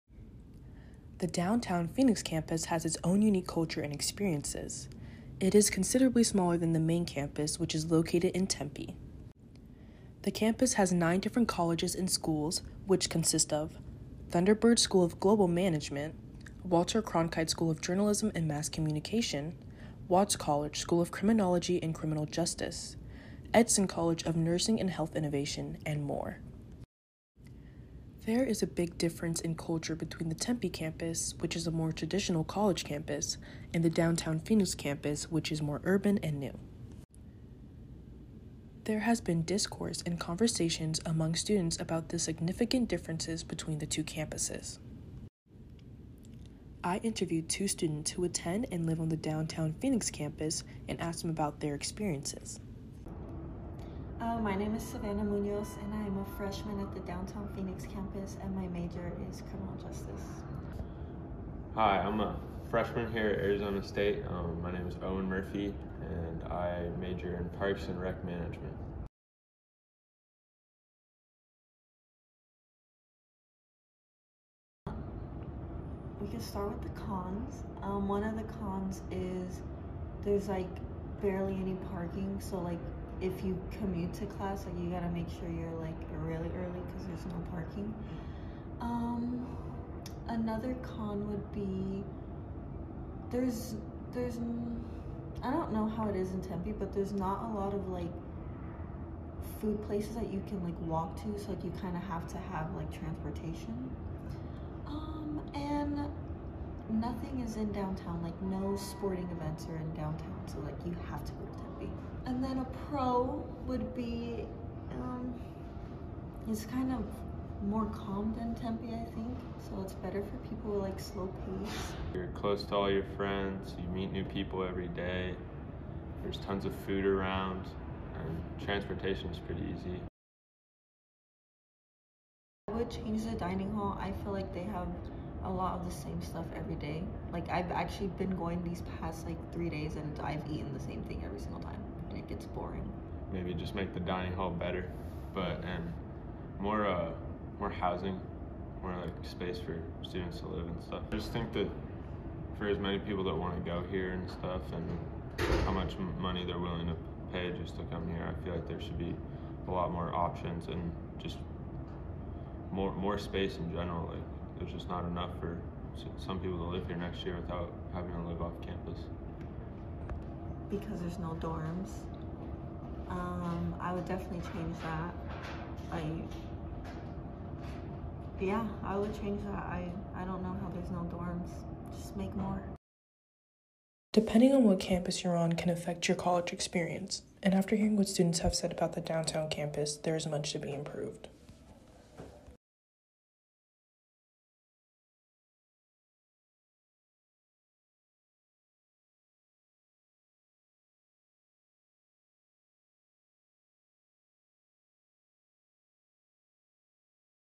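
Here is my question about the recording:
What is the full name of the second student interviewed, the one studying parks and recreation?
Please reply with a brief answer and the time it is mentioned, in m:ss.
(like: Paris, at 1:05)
Owen Murphy, at 1:05.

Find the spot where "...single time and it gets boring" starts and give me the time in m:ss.
2:21.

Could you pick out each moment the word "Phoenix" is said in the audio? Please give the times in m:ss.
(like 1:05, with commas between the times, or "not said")
0:01, 0:34, 0:49, 0:57.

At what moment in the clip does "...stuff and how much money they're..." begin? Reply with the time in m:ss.
2:34.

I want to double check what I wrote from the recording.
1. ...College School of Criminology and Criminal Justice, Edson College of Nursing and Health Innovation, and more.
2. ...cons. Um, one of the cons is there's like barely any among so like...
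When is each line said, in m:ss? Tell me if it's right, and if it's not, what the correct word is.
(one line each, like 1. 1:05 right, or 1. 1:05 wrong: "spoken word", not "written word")
1. 0:20 right
2. 1:17 wrong: "parking", not "among".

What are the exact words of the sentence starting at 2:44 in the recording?
Like there's just not enough for some people to live here next year without having to live off campus.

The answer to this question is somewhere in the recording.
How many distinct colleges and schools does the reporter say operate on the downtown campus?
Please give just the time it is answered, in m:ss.
0:10.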